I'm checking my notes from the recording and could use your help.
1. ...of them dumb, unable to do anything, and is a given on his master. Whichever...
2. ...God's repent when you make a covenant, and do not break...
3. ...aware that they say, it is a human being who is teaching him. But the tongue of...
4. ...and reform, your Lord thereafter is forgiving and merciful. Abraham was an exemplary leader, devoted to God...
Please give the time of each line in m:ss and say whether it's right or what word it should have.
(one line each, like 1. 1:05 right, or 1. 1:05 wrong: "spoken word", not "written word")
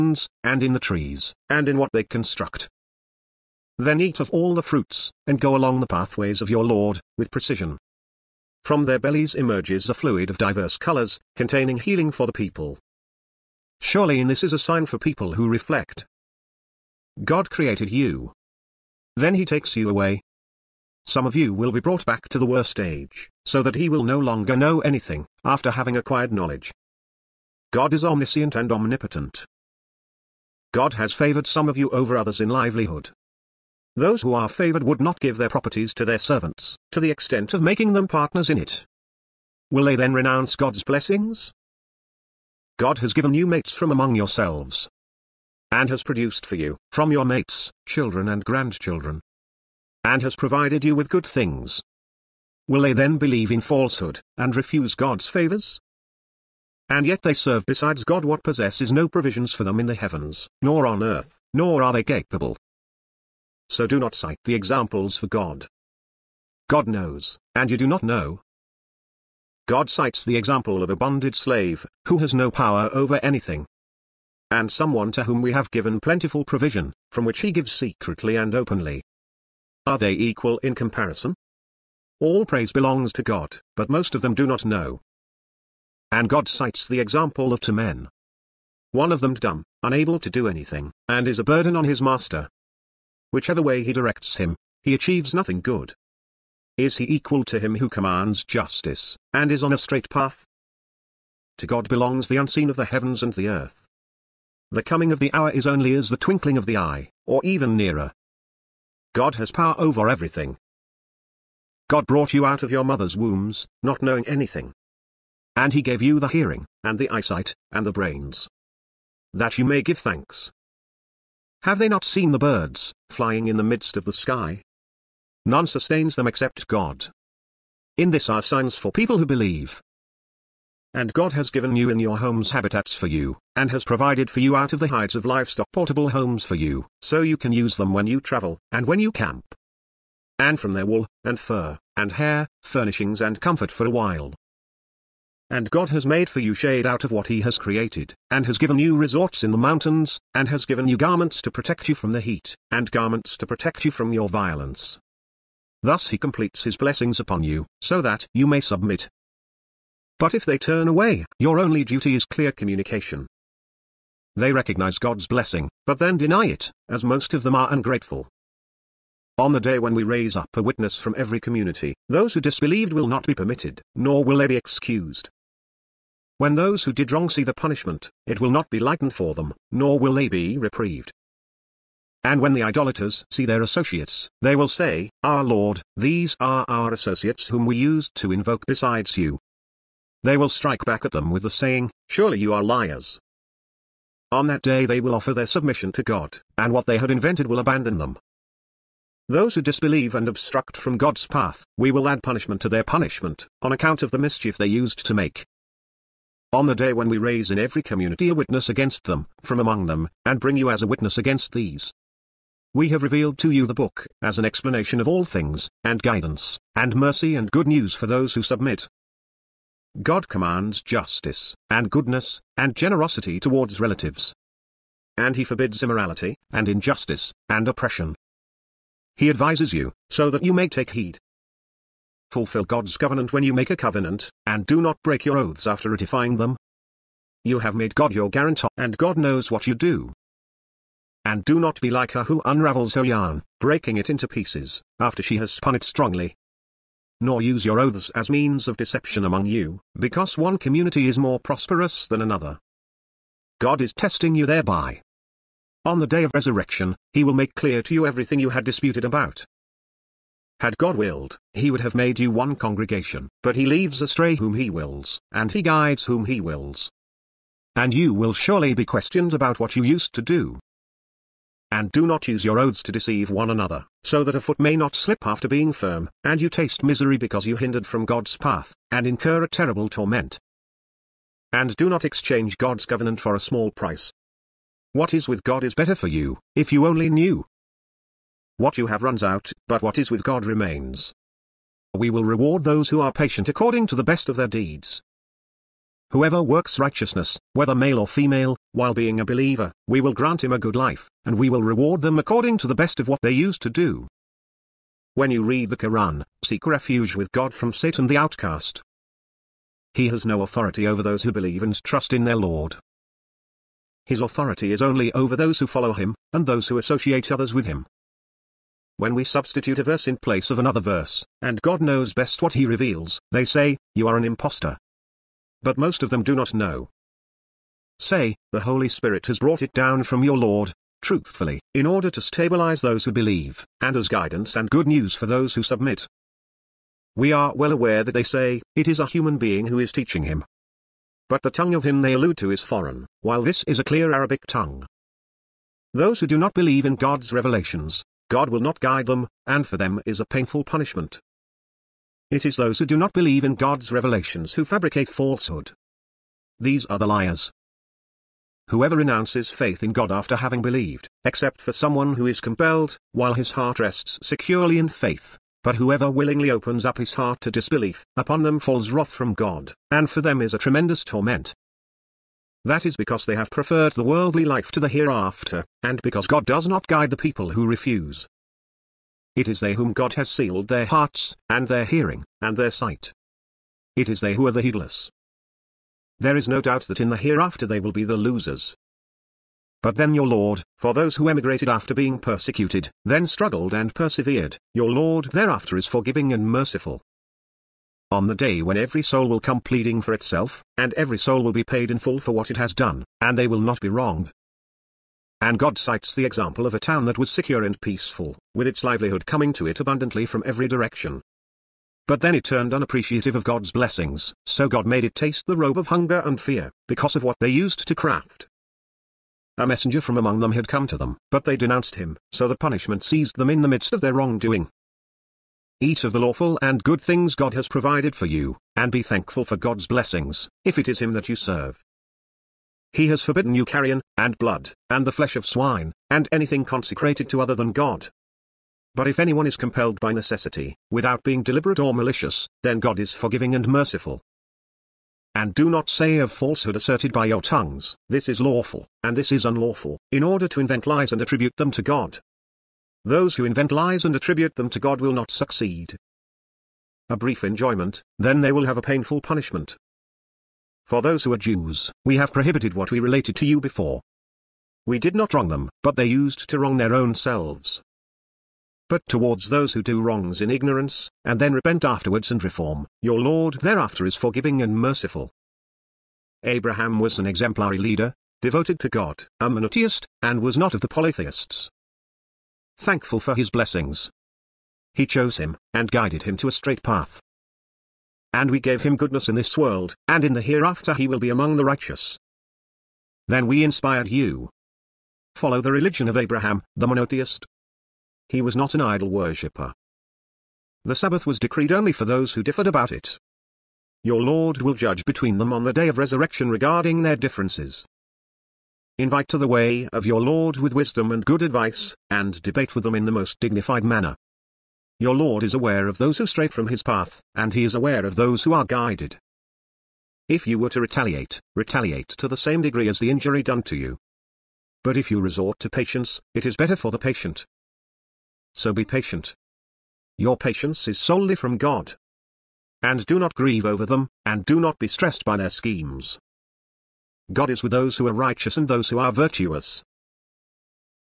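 1. 1:29 wrong: "burden", not "given"
2. 3:52 wrong: "covenant", not "repent"
3. 5:37 right
4. 7:52 right.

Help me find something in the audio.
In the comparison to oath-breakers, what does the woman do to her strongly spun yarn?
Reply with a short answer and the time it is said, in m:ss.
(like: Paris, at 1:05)
unravels, at 4:02.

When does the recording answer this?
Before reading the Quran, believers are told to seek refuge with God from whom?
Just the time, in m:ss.
5:07.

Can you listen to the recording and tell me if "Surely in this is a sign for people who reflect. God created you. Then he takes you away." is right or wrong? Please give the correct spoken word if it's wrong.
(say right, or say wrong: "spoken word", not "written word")
right.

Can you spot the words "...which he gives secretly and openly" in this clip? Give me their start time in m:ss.
1:17.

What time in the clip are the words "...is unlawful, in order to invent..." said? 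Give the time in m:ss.
7:29.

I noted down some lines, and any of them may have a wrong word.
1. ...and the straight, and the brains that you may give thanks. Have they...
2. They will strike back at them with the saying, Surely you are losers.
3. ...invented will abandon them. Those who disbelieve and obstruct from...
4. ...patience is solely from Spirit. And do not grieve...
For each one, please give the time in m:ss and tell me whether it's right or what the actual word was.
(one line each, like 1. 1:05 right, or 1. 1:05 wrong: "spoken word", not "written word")
1. 1:56 wrong: "eyesight", not "straight"
2. 3:10 wrong: "liars", not "losers"
3. 3:17 right
4. 8:50 wrong: "God", not "Spirit".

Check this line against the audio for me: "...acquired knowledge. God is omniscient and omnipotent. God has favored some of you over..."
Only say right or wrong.
right.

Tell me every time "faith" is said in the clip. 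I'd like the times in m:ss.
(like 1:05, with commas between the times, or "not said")
5:59, 6:04.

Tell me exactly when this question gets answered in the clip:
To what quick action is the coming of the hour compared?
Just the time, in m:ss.
1:46.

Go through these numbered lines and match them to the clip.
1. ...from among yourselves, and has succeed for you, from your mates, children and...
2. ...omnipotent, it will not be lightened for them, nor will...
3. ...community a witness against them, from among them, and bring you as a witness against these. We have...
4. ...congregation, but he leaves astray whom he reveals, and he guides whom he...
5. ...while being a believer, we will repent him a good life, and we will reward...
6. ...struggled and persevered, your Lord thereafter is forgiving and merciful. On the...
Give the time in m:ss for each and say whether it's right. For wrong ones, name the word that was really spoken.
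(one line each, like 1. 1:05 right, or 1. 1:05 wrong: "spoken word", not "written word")
1. 0:43 wrong: "produced", not "succeed"
2. 2:57 wrong: "punishment", not "omnipotent"
3. 3:27 right
4. 4:22 wrong: "wills", not "reveals"
5. 4:58 wrong: "grant", not "repent"
6. 6:33 right.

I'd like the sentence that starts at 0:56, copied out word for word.
And yet they serve besides God what possesses no provisions for them in the heavens, nor on earth, nor are they capable.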